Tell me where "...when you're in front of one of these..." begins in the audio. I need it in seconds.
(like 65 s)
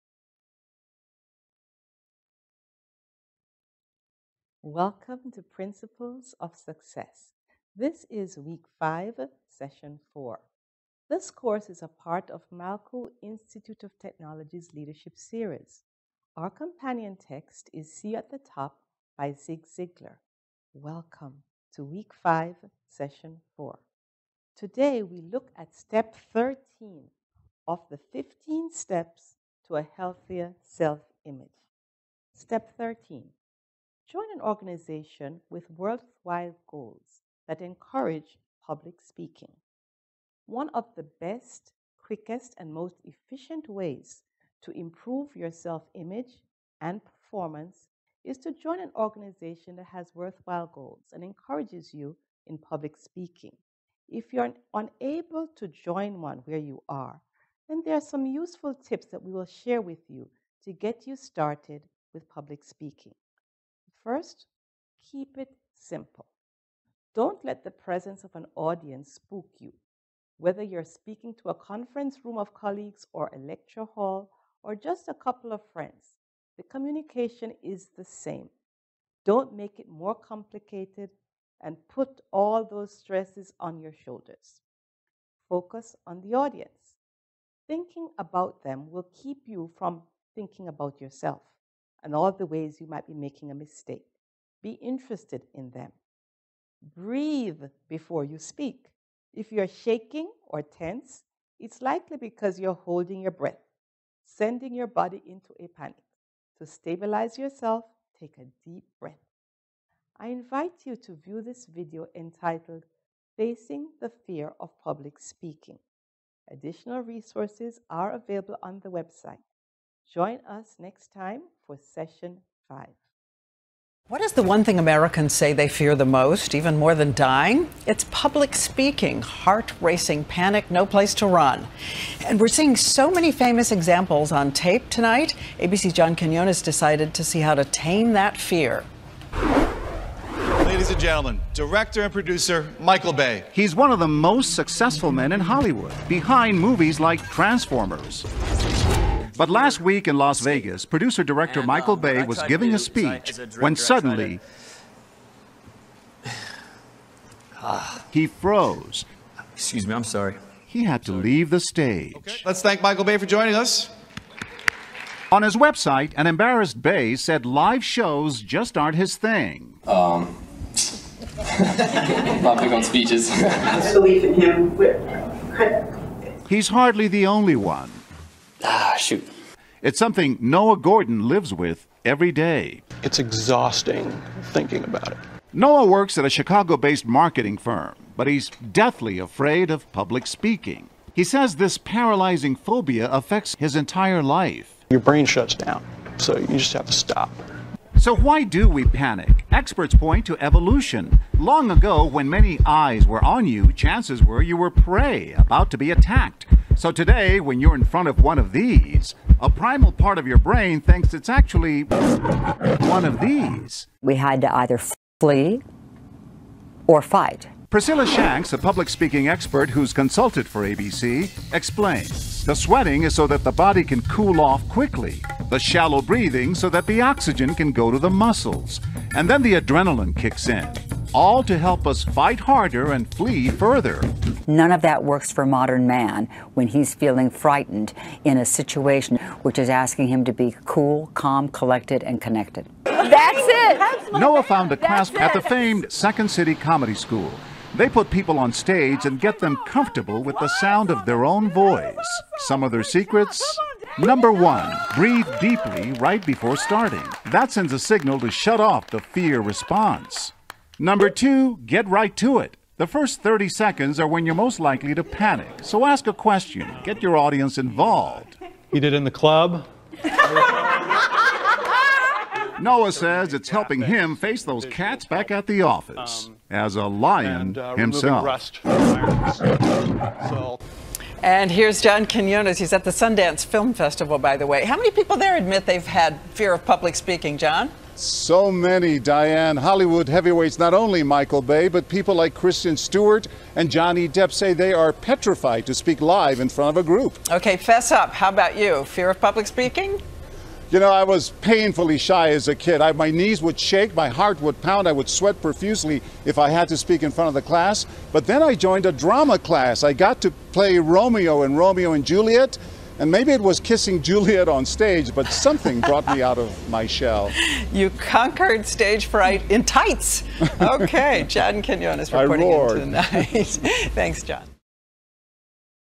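207 s.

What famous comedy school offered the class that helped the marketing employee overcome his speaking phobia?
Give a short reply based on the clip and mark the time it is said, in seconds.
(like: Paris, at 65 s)
Second City Comedy School, at 245 s.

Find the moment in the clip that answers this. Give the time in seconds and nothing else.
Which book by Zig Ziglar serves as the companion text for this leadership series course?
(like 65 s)
17 s.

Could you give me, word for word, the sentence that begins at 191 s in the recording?
He says this paralyzing phobia affects his entire life.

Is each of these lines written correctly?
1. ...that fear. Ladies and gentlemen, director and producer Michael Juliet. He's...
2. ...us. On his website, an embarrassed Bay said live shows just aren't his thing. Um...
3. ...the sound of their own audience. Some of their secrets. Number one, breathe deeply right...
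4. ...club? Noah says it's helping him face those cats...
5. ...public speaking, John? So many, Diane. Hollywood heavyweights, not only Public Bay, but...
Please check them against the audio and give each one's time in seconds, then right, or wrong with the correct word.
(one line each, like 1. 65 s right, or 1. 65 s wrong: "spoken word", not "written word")
1. 138 s wrong: "Bay", not "Juliet"
2. 163 s right
3. 250 s wrong: "voice", not "audience"
4. 269 s right
5. 286 s wrong: "Michael", not "Public".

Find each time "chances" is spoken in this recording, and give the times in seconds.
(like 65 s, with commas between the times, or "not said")
203 s.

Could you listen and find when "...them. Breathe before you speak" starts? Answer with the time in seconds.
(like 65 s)
95 s.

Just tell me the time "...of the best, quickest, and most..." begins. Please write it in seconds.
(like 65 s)
40 s.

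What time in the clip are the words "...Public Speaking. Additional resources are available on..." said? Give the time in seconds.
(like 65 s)
114 s.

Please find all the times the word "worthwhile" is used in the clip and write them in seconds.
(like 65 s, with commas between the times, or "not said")
35 s, 50 s.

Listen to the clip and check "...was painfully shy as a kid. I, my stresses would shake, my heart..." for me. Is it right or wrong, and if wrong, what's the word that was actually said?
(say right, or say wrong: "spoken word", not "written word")
wrong: "knees", not "stresses".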